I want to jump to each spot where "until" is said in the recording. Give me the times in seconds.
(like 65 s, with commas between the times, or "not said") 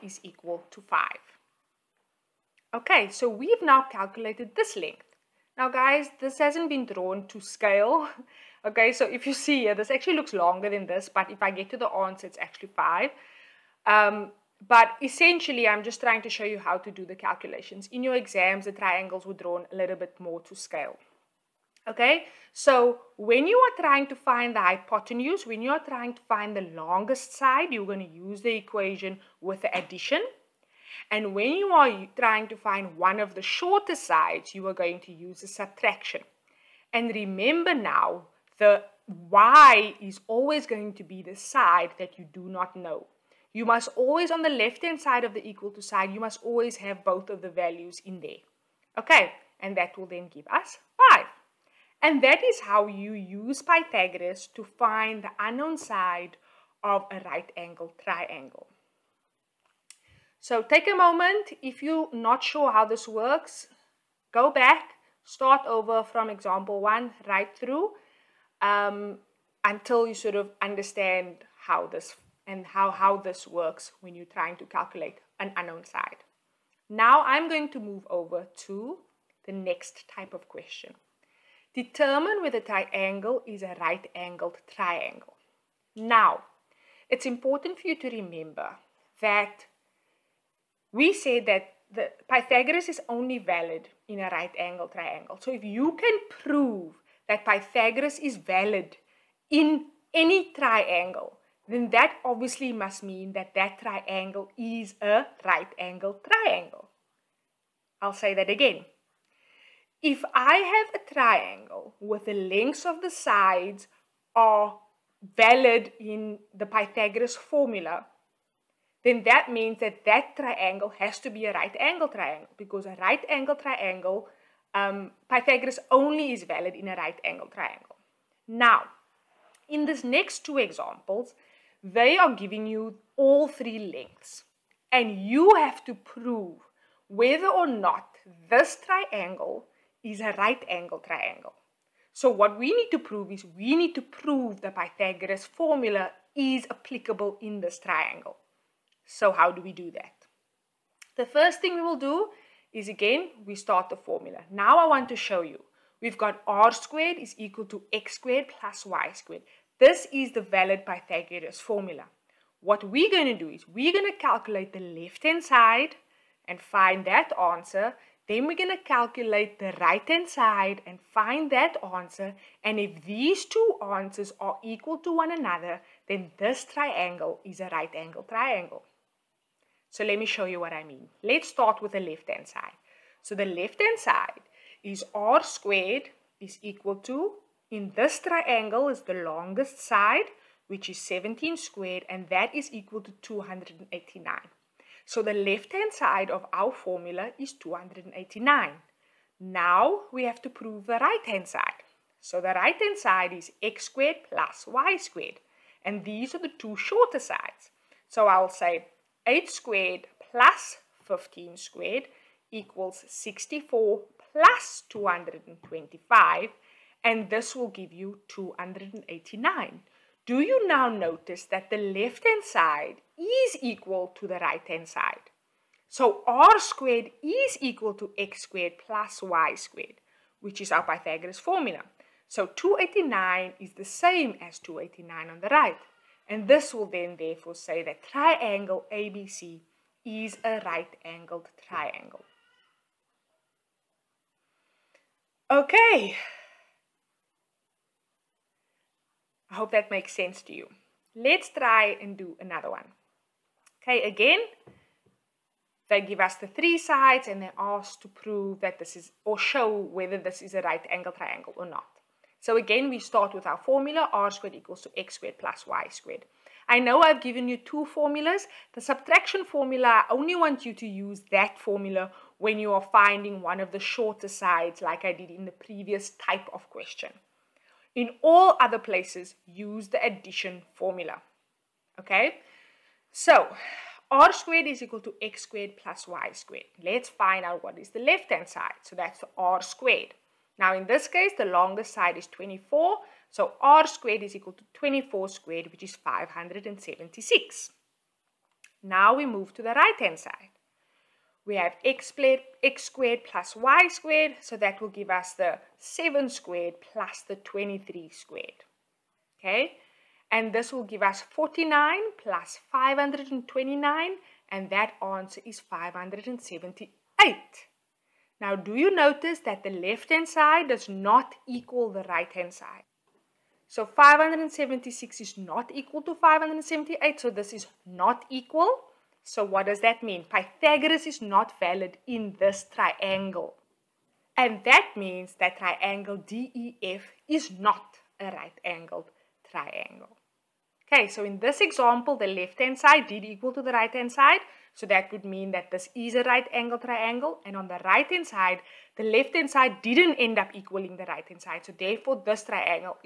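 69 s.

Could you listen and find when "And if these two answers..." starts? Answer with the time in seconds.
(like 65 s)
172 s.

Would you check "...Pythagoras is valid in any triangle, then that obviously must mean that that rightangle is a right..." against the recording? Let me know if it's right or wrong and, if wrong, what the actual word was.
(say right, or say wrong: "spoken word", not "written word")
wrong: "triangle", not "rightangle".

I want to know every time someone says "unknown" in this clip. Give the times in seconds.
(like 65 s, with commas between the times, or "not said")
55 s, 75 s.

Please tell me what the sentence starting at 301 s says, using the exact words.
We have x, x squared plus y squared, so that will give us the 7 squared plus the 23 squared.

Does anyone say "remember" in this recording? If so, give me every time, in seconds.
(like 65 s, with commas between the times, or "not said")
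37 s, 88 s.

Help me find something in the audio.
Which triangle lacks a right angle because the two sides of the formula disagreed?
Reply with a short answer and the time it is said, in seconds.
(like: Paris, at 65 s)
DEF, at 336 s.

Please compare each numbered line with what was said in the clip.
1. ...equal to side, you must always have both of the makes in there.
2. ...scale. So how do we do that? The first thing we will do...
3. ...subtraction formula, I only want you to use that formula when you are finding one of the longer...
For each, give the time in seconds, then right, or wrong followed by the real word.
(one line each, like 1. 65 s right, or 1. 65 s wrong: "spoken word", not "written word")
1. 45 s wrong: "values", not "makes"
2. 147 s wrong: "triangle", not "scale"
3. 268 s wrong: "shorter", not "longer".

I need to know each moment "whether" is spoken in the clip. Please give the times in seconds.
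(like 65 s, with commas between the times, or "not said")
82 s, 137 s, 259 s.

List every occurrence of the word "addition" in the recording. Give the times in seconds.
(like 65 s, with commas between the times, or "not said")
29 s, 280 s.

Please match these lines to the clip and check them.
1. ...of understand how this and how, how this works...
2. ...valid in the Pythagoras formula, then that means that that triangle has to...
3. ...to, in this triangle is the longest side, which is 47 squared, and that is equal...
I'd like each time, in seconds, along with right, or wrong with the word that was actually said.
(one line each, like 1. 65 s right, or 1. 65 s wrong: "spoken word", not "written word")
1. 70 s right
2. 115 s right
3. 186 s wrong: "17", not "47".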